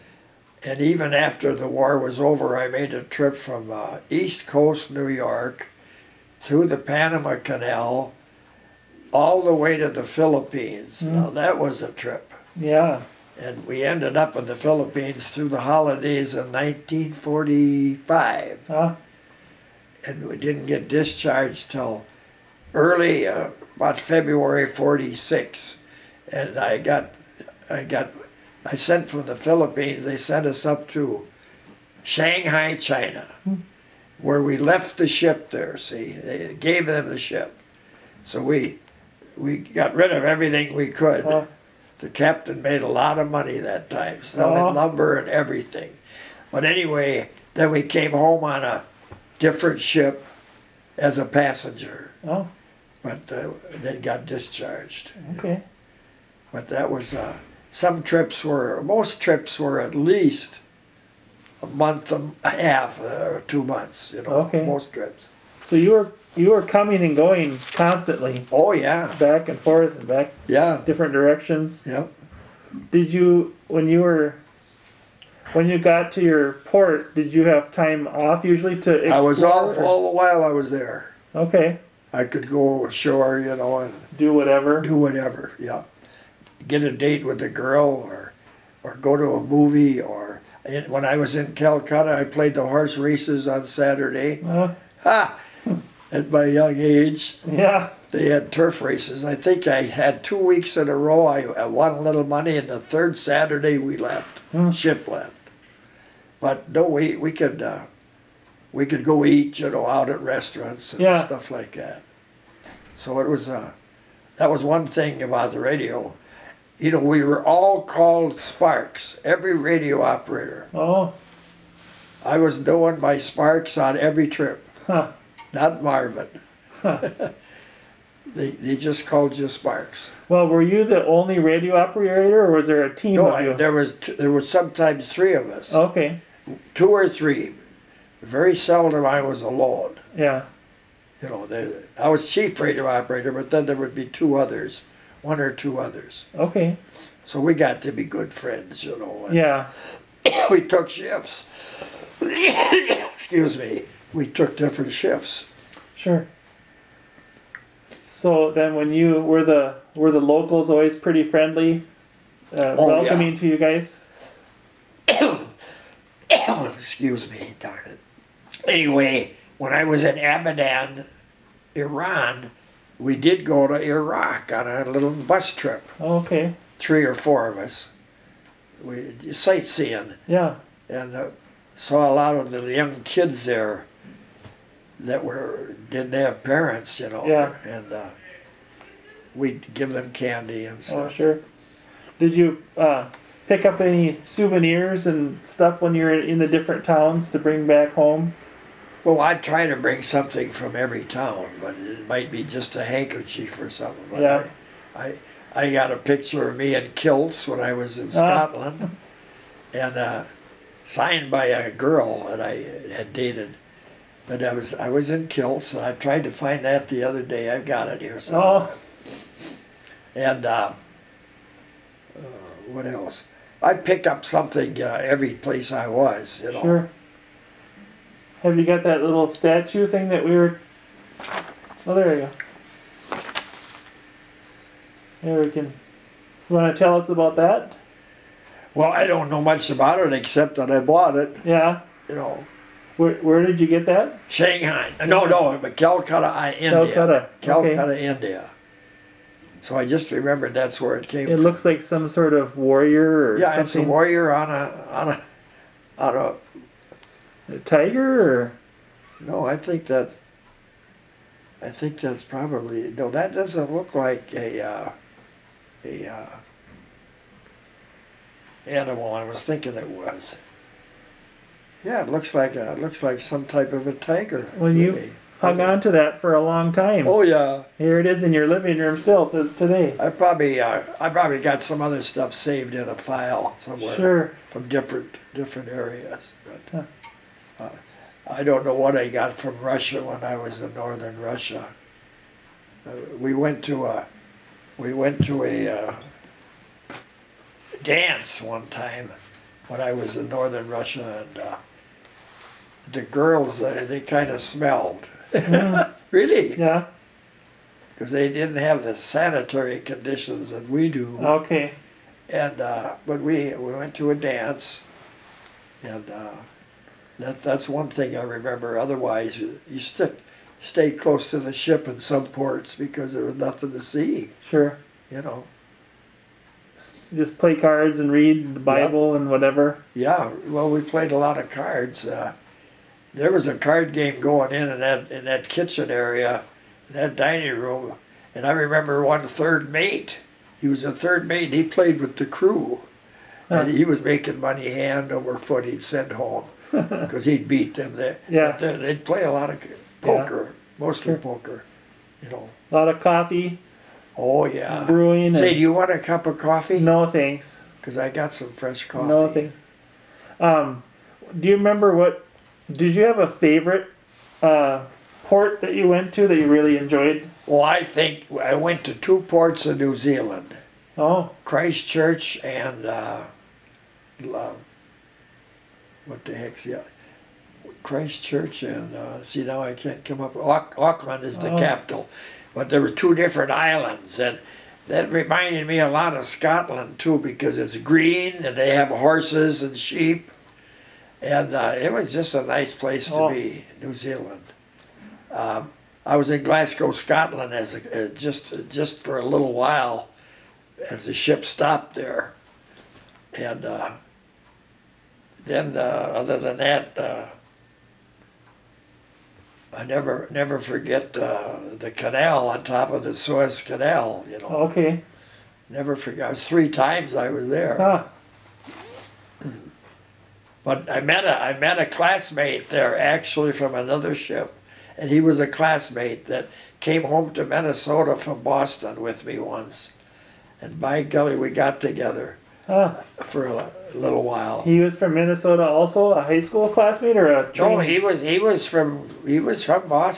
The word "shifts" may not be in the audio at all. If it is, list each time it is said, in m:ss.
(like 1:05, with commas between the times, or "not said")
2:30, 2:34.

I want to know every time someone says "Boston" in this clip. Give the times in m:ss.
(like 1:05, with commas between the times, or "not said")
7:08.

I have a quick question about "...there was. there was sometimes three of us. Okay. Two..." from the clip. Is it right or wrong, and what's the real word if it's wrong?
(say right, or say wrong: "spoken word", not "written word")
right.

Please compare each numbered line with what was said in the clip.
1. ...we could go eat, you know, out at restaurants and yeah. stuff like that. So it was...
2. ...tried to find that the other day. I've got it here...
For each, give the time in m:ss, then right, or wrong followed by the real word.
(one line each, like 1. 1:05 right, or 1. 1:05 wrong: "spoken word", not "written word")
1. 1:48 right
2. 3:35 right.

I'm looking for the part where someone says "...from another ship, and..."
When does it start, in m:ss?
7:03.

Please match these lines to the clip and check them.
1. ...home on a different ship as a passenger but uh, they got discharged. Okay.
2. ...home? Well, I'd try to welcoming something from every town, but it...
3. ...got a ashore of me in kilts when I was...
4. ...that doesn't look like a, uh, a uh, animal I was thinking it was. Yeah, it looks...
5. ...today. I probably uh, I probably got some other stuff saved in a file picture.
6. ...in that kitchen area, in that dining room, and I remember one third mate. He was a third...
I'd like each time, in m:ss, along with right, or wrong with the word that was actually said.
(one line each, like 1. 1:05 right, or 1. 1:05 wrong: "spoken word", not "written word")
1. 0:48 right
2. 3:17 wrong: "bring", not "welcoming"
3. 3:25 wrong: "picture", not "ashore"
4. 4:23 right
5. 4:39 wrong: "somewhere", not "picture"
6. 5:35 right.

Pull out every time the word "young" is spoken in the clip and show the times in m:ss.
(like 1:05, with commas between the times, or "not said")
1:36, 3:02.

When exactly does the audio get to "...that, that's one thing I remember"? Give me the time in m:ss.
5:17.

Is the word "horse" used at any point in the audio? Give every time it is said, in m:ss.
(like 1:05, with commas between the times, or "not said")
1:32, 6:28.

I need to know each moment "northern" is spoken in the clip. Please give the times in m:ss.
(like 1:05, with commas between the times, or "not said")
4:50, 5:00.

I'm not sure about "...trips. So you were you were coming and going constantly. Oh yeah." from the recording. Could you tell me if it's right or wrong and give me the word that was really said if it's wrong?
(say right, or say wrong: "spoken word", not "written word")
right.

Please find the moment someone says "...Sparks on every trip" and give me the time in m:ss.
2:03.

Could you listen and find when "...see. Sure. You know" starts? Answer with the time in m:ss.
5:23.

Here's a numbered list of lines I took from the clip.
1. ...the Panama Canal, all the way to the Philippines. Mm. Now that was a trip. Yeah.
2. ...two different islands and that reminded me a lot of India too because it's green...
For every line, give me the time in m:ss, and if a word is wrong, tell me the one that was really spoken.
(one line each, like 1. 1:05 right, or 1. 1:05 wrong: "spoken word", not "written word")
1. 0:06 right
2. 6:22 wrong: "Scotland", not "India".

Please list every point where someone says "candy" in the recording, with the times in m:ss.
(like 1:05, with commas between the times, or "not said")
3:10.